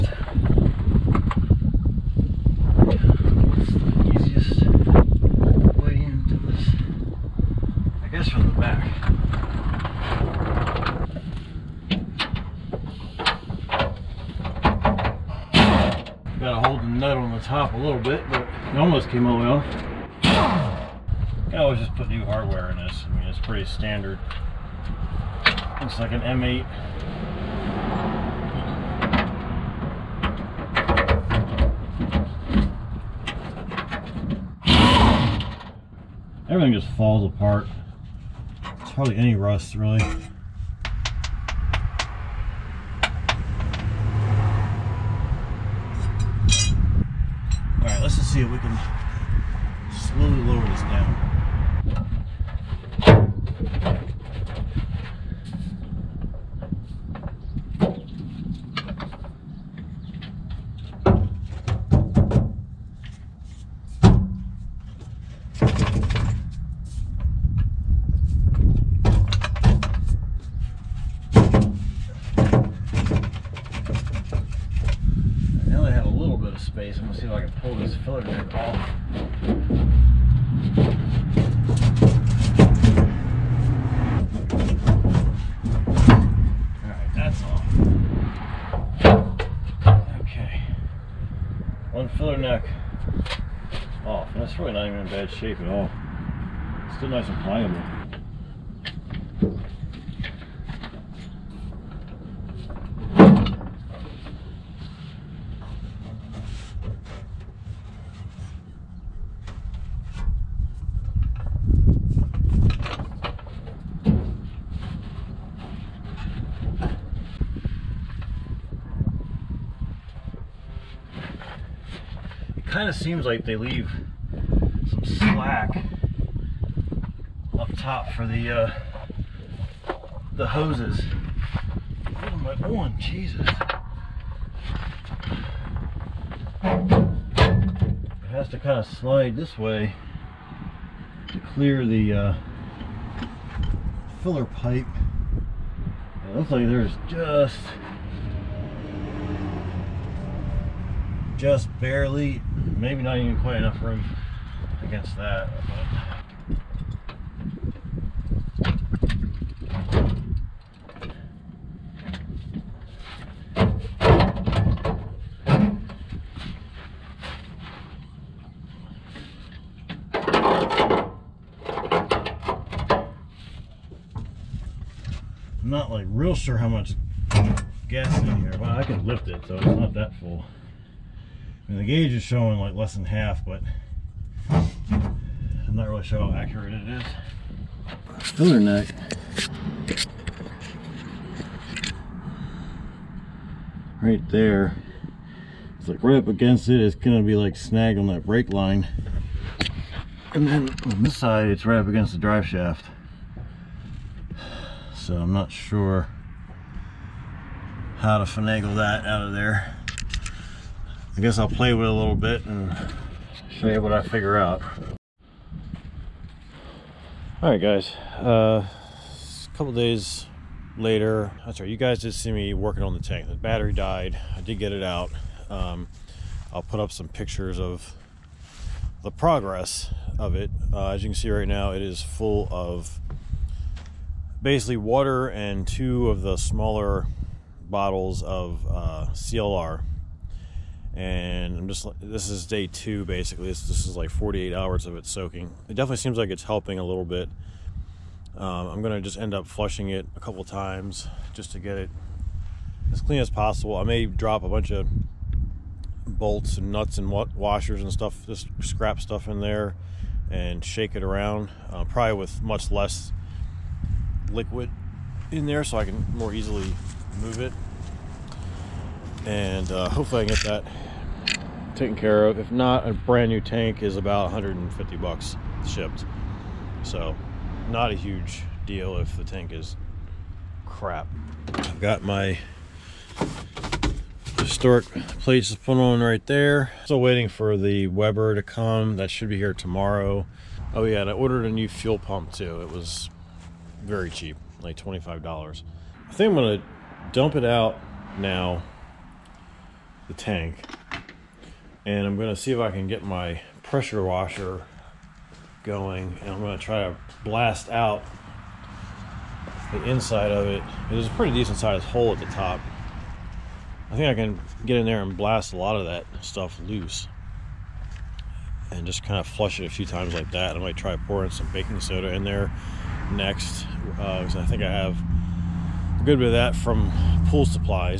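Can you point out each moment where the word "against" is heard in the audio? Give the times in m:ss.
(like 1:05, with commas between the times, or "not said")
2:34, 3:16, 3:21.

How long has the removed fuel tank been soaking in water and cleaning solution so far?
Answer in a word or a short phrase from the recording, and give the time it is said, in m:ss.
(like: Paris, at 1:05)
48 hours, at 4:04.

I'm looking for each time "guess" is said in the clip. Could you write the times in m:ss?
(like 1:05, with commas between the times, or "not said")
0:08, 3:31.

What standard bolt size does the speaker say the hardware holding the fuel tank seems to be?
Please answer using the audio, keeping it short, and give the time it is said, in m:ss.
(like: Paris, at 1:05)
M8, at 0:26.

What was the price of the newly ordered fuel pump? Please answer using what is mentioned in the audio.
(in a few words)
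$25.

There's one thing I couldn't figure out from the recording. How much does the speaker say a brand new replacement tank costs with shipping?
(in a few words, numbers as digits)
$150.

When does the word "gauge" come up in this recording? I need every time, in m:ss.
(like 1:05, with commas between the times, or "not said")
3:01.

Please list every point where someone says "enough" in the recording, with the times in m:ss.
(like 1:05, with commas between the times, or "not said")
2:33.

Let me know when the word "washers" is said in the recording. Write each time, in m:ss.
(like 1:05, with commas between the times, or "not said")
4:17, 5:04.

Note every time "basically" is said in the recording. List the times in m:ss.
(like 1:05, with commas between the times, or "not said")
3:54, 4:03.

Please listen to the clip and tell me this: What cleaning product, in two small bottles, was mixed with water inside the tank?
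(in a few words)
CLR.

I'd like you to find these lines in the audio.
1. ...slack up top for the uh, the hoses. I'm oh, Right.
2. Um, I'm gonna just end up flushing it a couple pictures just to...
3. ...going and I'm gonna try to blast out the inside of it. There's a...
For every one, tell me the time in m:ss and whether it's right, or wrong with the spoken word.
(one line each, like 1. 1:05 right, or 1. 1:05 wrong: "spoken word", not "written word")
1. 2:05 wrong: "Jesus", not "Right"
2. 4:08 wrong: "times", not "pictures"
3. 5:05 right.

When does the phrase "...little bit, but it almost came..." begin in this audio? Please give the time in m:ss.
0:17.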